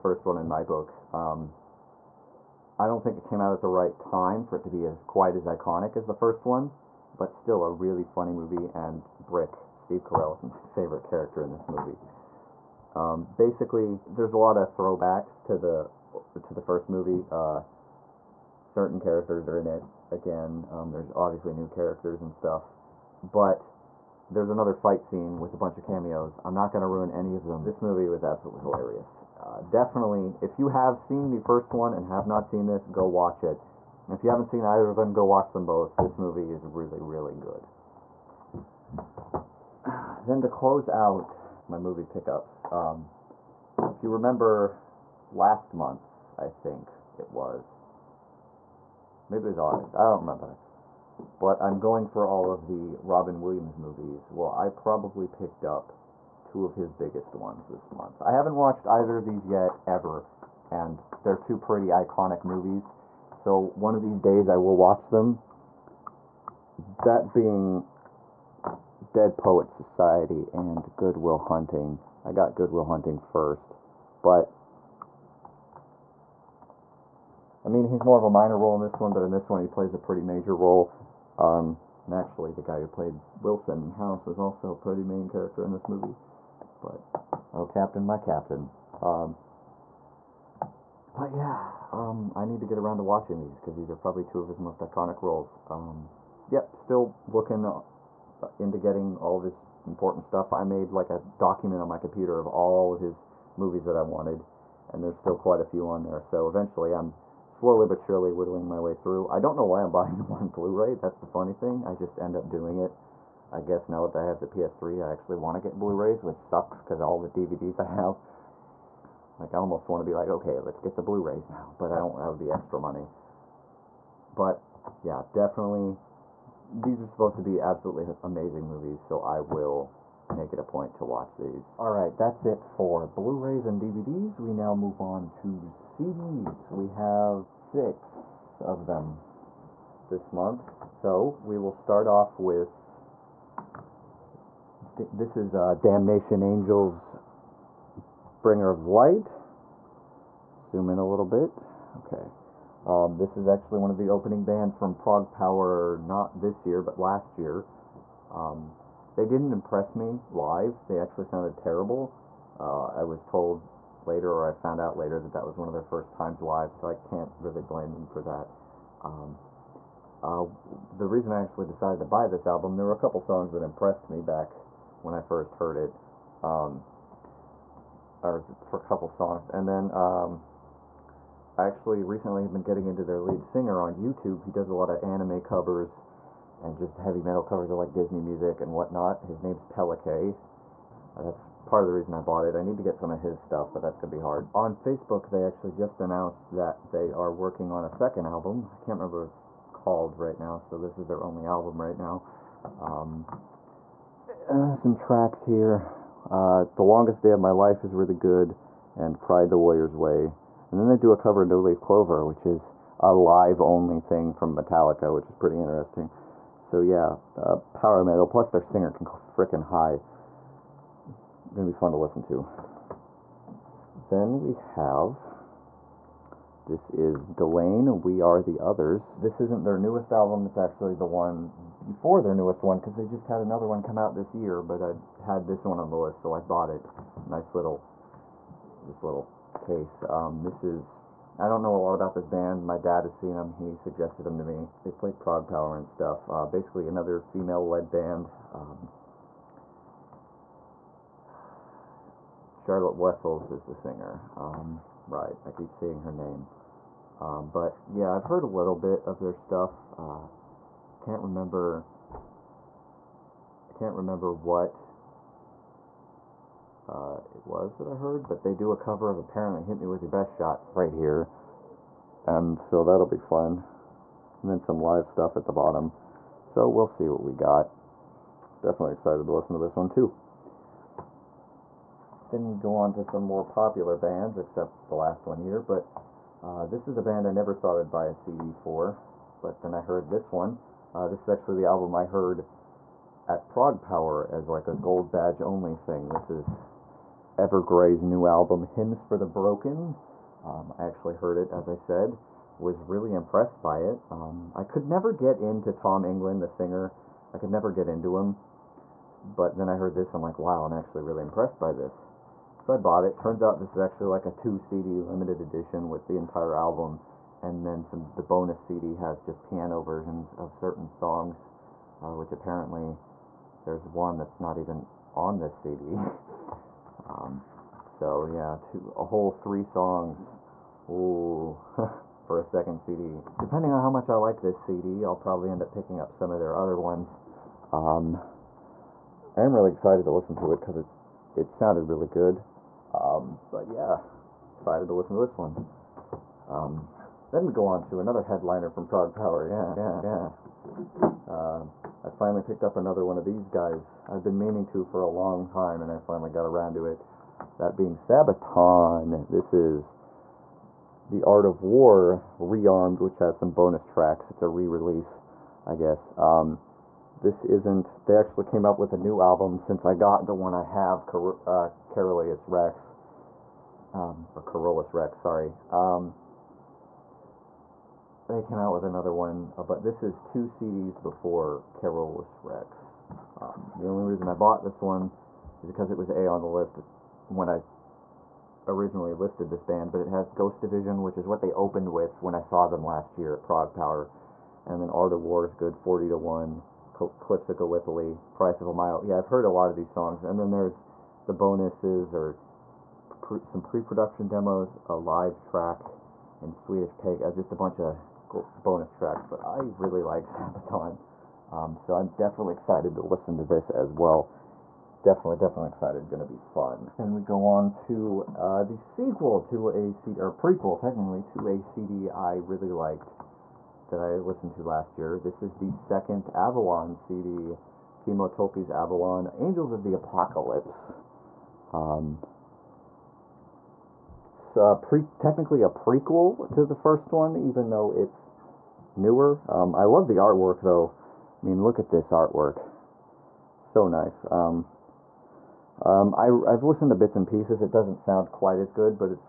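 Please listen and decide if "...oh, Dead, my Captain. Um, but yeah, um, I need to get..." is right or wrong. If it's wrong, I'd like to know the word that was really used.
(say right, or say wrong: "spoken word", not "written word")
wrong: "Captain", not "Dead".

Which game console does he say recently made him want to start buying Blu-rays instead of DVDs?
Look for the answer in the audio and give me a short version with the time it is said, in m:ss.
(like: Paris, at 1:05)
PS3, at 1:54.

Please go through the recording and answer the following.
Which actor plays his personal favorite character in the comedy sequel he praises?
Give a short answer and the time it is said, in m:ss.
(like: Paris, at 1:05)
Steve Carell, at 0:09.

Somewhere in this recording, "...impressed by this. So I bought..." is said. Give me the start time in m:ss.
5:11.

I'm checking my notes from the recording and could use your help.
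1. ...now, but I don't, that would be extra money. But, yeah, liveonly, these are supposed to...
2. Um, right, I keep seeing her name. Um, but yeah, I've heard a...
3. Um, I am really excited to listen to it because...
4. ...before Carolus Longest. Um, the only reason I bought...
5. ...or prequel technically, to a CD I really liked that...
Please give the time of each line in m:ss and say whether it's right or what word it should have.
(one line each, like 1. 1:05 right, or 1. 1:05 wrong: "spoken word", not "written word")
1. 2:01 wrong: "definitely", not "liveonly"
2. 4:14 right
3. 5:37 right
4. 6:21 wrong: "Rex", not "Longest"
5. 7:00 right.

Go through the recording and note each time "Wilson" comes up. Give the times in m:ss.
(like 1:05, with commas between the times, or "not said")
1:23.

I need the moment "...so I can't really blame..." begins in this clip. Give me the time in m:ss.
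2:46.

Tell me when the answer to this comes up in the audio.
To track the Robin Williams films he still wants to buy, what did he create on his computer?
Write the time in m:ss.
1:41.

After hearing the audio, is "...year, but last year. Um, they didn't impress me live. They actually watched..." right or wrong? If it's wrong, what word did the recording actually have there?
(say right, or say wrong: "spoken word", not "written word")
wrong: "sounded", not "watched".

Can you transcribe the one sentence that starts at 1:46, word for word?
So eventually I'm slowly but surely whittling my way through.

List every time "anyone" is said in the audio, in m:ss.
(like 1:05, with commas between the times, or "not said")
not said.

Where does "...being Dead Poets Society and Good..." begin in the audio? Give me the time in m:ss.
1:07.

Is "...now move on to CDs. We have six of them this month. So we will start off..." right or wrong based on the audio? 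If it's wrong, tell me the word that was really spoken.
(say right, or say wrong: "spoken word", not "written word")
right.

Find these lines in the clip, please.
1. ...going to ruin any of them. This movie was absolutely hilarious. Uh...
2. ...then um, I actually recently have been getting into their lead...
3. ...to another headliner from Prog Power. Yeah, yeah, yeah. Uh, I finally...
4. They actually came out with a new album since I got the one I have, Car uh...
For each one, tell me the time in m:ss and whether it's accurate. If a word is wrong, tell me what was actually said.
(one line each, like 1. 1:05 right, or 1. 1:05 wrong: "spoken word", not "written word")
1. 0:26 right
2. 2:59 right
3. 5:47 right
4. 6:08 right.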